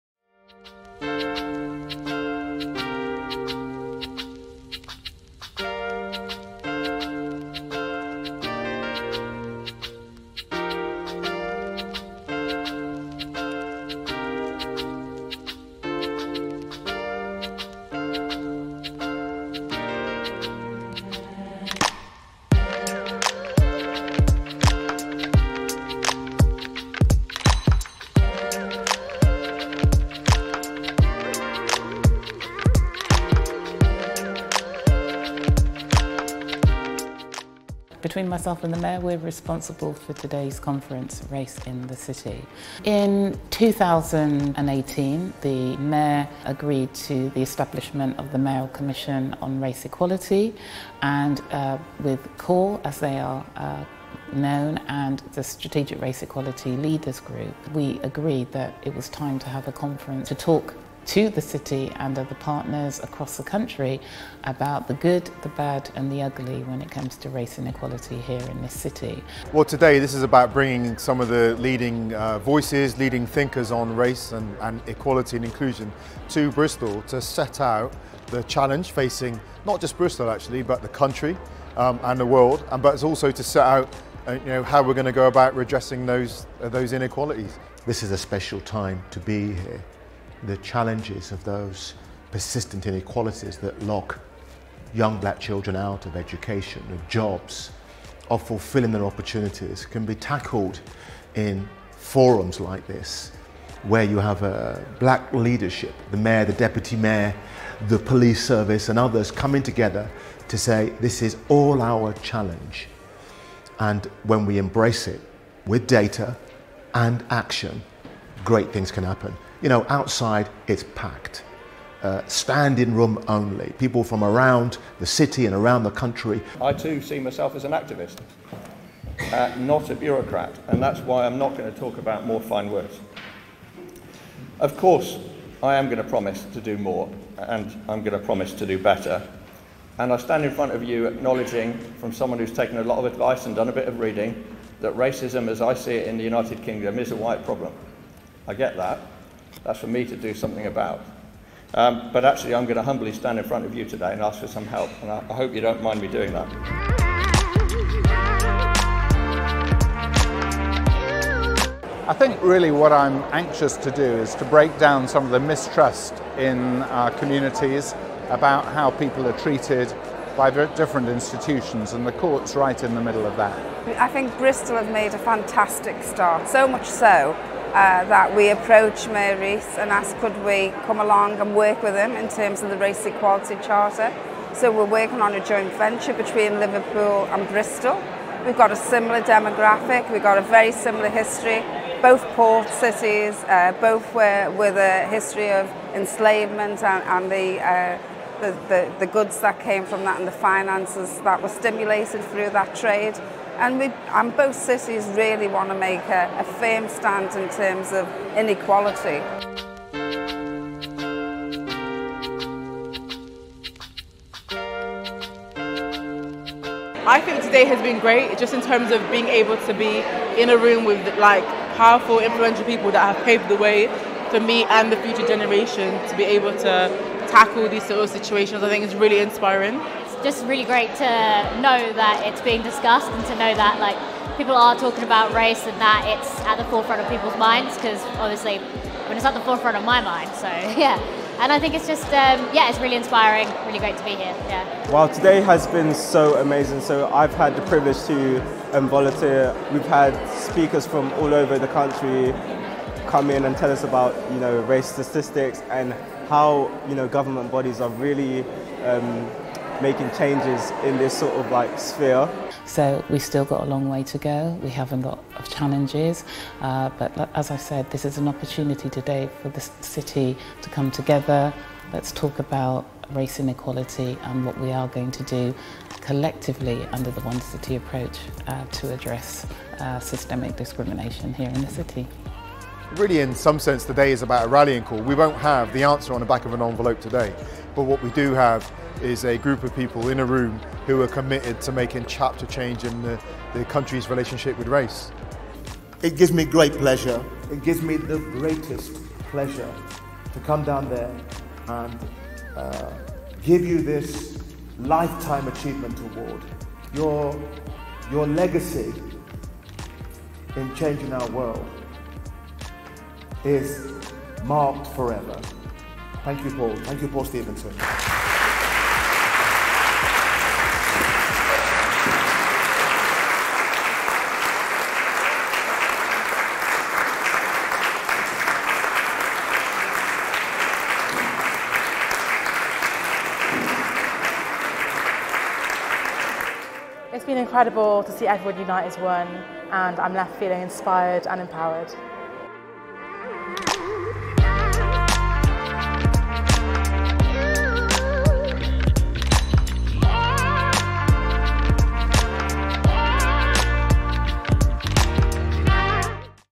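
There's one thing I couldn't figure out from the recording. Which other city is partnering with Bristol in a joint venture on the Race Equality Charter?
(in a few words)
Liverpool.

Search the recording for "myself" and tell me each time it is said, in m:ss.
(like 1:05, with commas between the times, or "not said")
0:38, 2:07.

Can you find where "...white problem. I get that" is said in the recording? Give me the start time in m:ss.
2:27.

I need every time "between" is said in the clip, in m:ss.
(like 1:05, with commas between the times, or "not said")
0:38, 3:06.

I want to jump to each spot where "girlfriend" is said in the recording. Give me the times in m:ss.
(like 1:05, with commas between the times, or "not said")
not said.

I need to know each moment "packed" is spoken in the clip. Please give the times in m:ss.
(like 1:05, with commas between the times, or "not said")
2:00.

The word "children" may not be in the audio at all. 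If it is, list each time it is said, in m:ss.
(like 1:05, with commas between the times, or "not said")
1:35.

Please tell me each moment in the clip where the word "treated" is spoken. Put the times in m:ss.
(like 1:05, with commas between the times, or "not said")
2:49.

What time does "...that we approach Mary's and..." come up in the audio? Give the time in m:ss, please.
2:58.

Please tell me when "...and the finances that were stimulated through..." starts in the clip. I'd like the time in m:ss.
3:20.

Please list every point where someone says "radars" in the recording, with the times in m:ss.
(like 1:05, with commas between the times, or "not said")
not said.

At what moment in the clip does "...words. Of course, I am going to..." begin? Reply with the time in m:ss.
2:12.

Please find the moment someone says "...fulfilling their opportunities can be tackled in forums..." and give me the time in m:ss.
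1:38.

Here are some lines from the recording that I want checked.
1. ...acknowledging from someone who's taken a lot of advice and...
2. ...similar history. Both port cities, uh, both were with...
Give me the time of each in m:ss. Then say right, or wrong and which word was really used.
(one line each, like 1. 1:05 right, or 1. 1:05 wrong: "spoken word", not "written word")
1. 2:21 right
2. 3:10 right.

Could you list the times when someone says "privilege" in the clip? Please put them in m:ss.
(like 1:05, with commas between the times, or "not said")
4:07.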